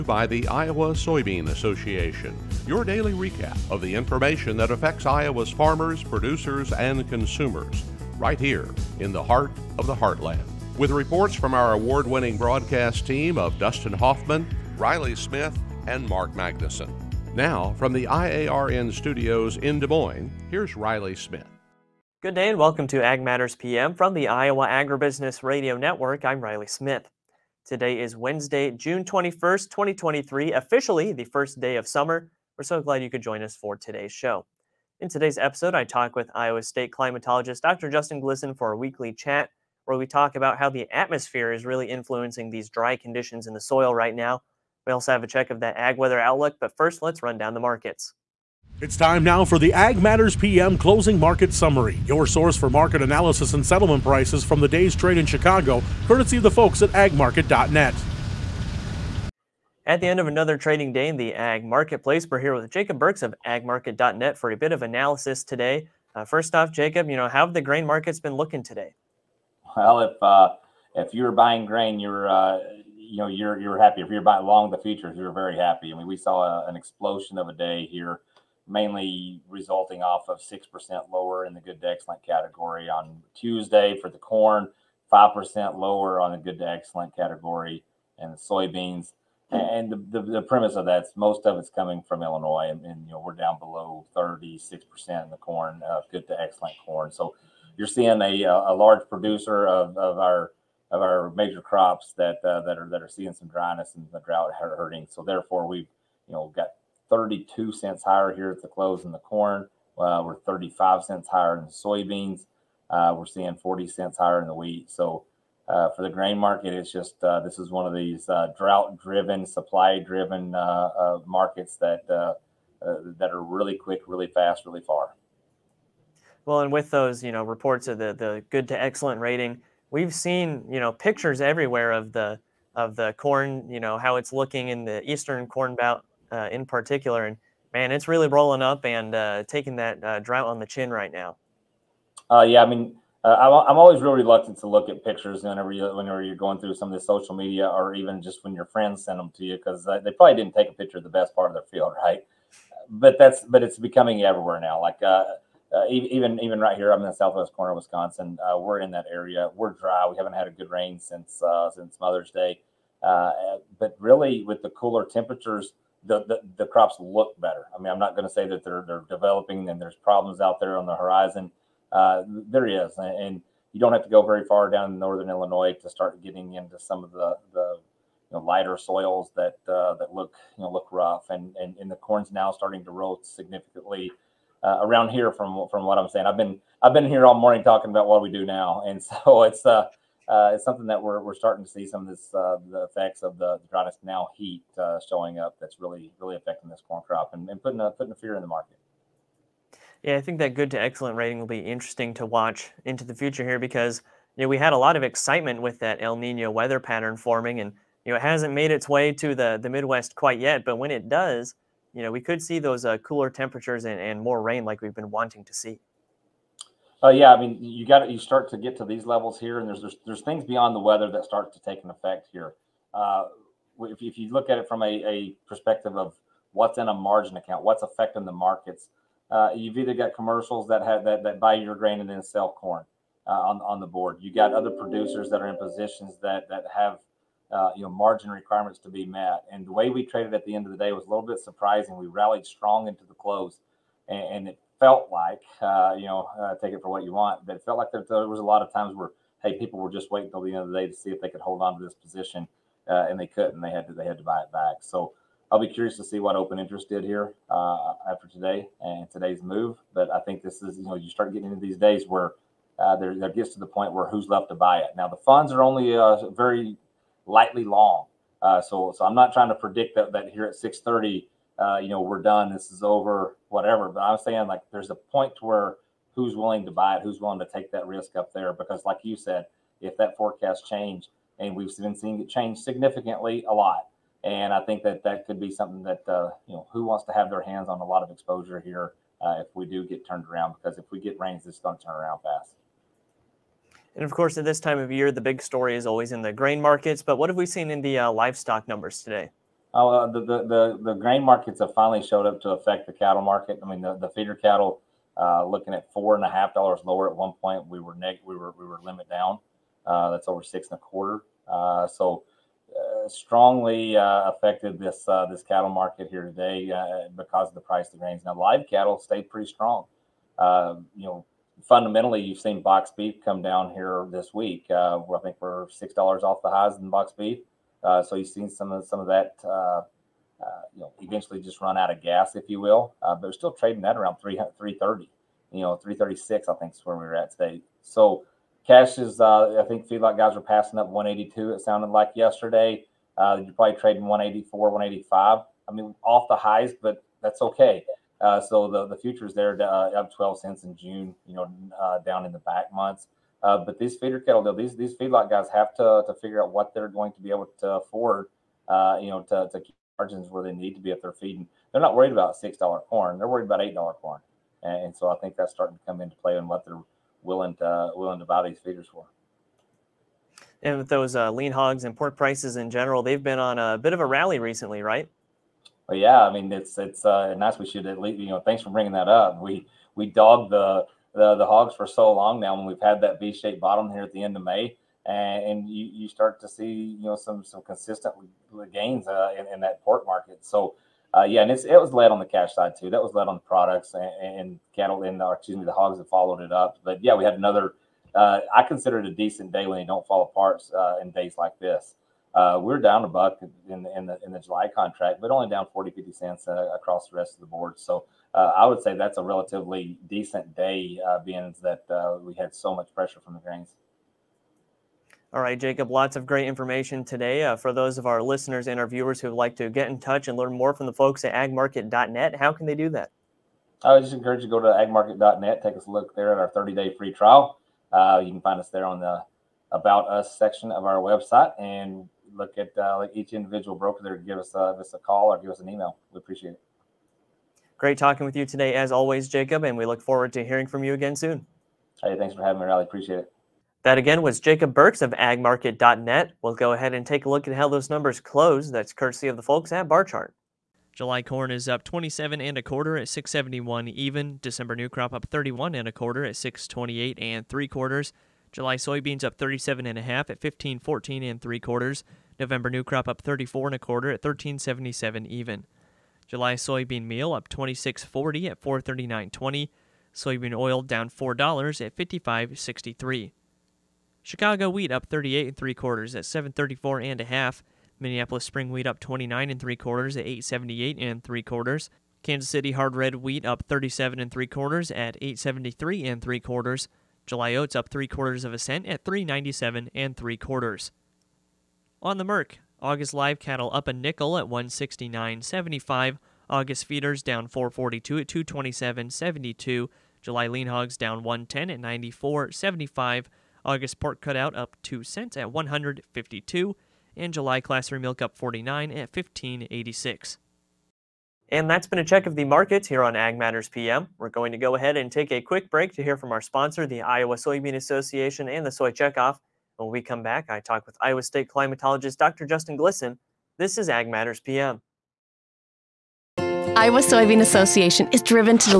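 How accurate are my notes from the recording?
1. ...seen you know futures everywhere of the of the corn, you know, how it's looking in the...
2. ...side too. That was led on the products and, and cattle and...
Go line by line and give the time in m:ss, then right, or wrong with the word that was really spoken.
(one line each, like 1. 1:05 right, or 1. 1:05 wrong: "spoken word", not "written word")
1. 2:10 wrong: "pictures", not "futures"
2. 6:32 right.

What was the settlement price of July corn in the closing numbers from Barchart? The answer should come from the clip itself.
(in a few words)
671.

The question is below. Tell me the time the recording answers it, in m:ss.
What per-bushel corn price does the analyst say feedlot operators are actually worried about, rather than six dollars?
6:03.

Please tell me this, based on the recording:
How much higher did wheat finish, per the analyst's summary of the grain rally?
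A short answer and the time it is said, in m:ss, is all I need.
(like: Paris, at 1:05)
40 cents, at 1:53.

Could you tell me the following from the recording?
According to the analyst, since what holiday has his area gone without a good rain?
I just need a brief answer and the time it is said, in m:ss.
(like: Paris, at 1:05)
Mother's Day, at 2:42.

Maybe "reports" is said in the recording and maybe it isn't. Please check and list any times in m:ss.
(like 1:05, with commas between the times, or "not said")
0:10, 2:07.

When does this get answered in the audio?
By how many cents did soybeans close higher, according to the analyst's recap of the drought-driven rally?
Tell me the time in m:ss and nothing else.
1:50.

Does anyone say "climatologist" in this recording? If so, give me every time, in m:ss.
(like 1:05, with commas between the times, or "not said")
0:36, 8:41.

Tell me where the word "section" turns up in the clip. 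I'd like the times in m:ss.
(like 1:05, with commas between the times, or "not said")
7:10.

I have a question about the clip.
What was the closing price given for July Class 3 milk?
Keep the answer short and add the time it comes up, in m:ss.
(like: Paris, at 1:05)
15.86, at 8:29.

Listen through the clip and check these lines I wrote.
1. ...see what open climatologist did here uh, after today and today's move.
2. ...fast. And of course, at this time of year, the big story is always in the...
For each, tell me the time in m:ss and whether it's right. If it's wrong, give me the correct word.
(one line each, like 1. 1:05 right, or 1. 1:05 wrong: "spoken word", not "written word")
1. 4:16 wrong: "interest", not "climatologist"
2. 4:52 right.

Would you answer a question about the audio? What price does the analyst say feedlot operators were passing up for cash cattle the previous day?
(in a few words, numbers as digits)
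182.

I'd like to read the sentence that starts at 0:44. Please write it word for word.
We also have a check of that ag weather outlook, but first let's run down the markets.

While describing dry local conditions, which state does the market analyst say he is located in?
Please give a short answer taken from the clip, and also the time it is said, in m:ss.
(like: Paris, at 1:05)
Wisconsin, at 2:37.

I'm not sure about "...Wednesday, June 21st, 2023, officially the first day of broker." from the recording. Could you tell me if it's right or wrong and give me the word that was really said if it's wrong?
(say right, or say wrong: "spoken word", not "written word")
wrong: "summer", not "broker".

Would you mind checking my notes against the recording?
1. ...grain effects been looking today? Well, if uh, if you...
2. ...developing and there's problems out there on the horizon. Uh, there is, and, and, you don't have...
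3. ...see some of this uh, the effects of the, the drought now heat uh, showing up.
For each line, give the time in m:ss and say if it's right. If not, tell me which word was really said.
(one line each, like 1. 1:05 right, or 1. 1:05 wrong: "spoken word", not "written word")
1. 1:07 wrong: "markets", not "effects"
2. 2:49 right
3. 3:11 right.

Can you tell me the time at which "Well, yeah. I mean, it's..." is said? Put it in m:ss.
6:15.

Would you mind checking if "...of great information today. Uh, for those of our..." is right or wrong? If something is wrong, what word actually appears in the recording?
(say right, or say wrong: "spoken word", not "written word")
right.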